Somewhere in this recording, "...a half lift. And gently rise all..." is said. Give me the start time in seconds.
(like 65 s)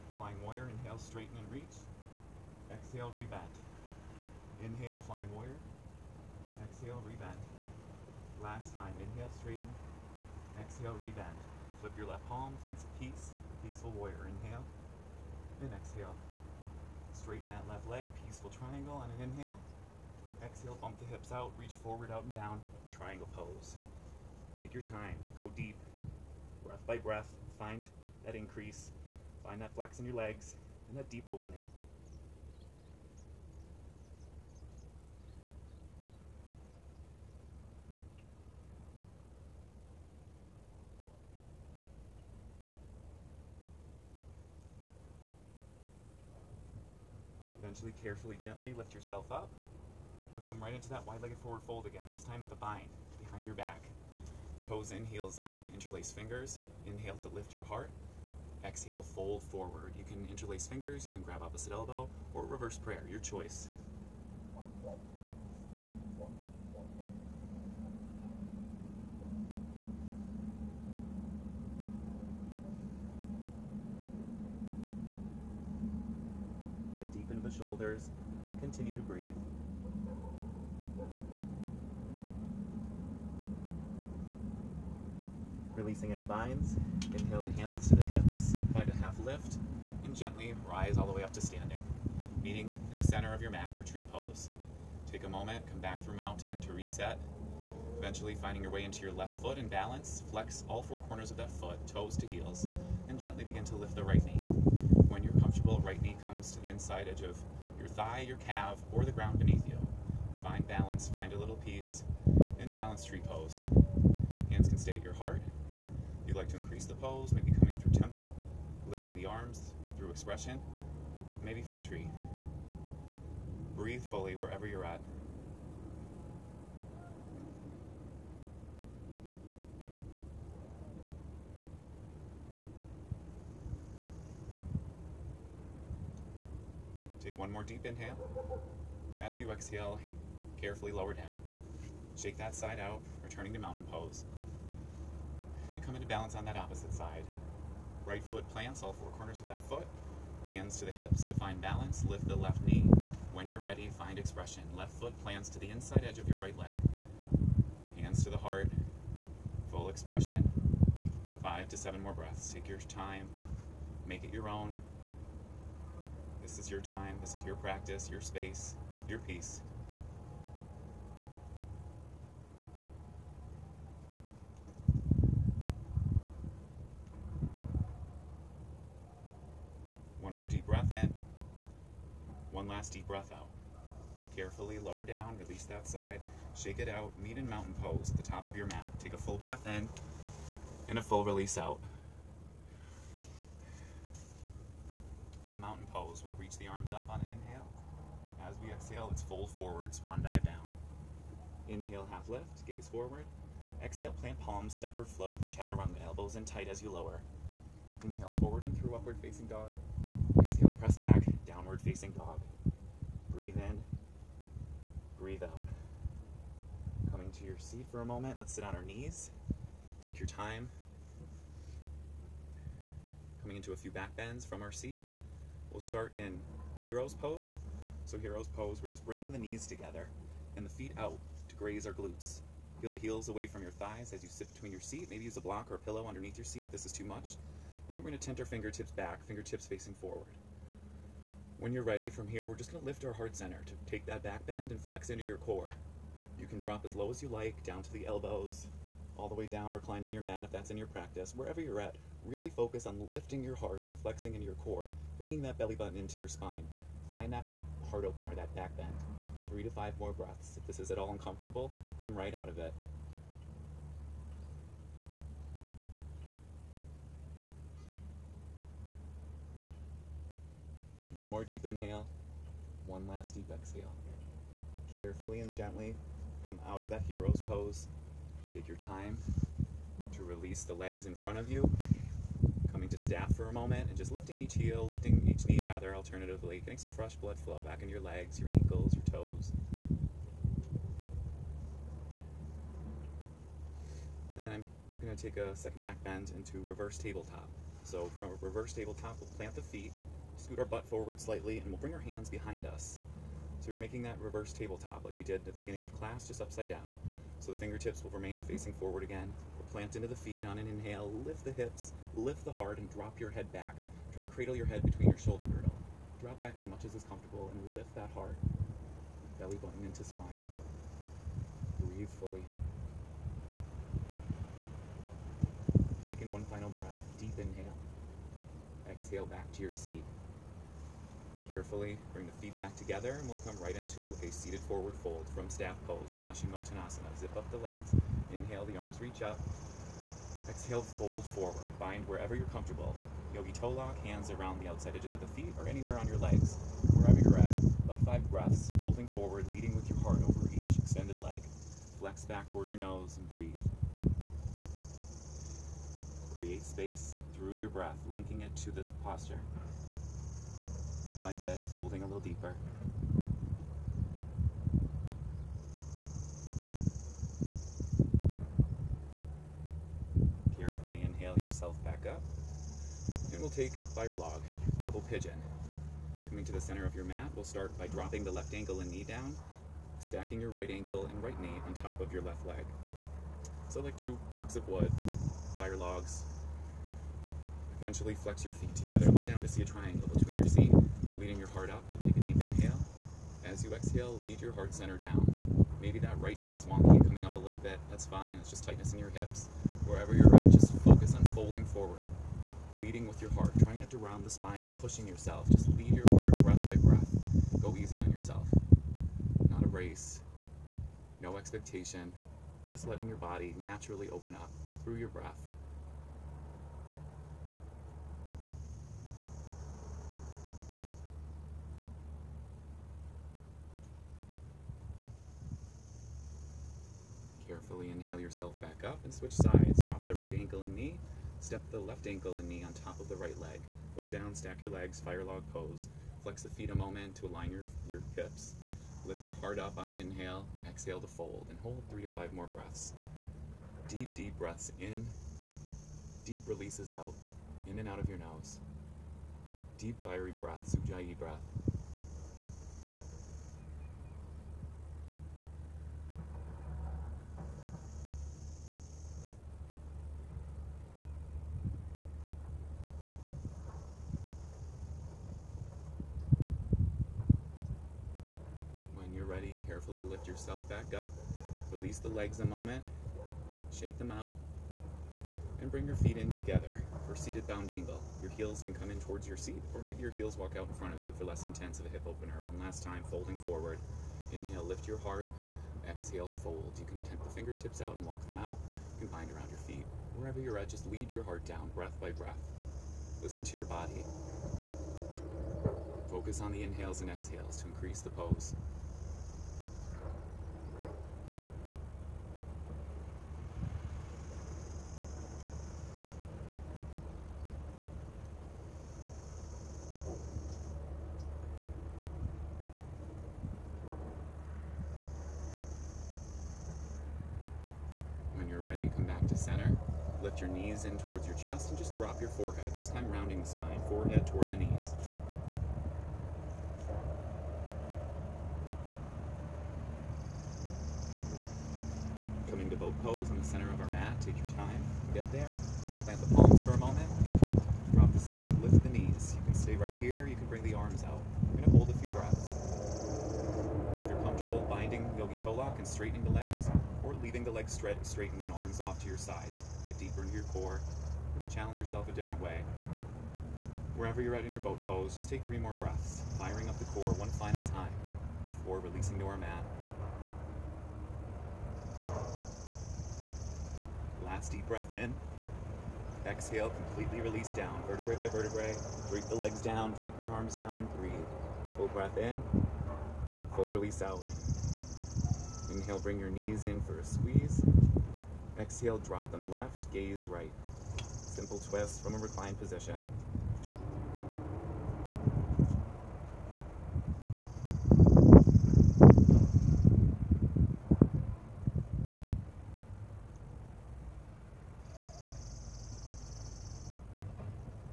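88 s.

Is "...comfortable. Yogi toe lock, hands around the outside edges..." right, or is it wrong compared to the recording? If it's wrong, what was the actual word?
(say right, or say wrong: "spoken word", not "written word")
right.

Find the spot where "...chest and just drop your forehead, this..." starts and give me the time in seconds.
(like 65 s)
521 s.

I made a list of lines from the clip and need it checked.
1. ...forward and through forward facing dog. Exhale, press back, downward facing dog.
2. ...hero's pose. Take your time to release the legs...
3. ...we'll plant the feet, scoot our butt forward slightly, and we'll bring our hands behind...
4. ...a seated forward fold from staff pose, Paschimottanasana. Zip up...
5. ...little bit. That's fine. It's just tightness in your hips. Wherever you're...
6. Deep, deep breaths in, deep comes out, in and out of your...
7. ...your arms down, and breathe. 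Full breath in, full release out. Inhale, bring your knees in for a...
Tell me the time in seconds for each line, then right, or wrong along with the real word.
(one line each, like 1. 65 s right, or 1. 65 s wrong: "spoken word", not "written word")
1. 208 s wrong: "upward", not "forward"
2. 277 s right
3. 299 s right
4. 334 s right
5. 397 s right
6. 443 s wrong: "releases", not "comes"
7. 570 s right.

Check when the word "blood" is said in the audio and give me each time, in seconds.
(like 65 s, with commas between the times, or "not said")
287 s.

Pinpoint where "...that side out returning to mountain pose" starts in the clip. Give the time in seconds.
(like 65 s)
142 s.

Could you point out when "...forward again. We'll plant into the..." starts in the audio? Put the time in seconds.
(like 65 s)
308 s.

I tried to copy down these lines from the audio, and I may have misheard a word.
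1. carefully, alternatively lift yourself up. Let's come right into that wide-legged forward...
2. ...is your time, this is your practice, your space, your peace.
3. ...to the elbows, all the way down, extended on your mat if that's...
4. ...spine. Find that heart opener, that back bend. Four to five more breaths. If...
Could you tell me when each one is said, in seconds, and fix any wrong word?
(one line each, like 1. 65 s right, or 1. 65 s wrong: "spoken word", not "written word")
1. 48 s wrong: "gently", not "alternatively"
2. 166 s right
3. 247 s wrong: "reclined", not "extended"
4. 256 s wrong: "Three", not "Four".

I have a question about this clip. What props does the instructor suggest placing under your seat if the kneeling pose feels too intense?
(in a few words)
a block or a pillow.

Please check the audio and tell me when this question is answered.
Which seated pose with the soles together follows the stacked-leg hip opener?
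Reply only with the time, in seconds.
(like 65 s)
477 s.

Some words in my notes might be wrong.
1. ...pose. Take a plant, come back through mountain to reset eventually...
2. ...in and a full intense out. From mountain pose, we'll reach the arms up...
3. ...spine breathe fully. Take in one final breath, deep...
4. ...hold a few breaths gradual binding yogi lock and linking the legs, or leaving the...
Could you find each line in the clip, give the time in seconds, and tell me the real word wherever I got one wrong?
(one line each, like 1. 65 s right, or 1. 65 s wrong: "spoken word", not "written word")
1. 94 s wrong: "moment", not "plant"
2. 189 s wrong: "release", not "intense"
3. 320 s right
4. 541 s wrong: "straightening", not "linking".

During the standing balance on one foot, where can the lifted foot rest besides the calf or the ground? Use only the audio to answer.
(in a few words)
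inside edge of your thigh.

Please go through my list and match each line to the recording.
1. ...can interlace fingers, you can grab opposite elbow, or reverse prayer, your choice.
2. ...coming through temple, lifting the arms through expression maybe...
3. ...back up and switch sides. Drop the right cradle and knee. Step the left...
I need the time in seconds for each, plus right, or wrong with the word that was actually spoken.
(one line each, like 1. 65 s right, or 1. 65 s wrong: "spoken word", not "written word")
1. 60 s right
2. 117 s right
3. 428 s wrong: "ankle", not "cradle".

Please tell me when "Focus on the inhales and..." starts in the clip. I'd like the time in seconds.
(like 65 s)
496 s.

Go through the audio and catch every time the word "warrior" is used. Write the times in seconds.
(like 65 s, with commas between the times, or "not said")
0 s, 5 s, 13 s.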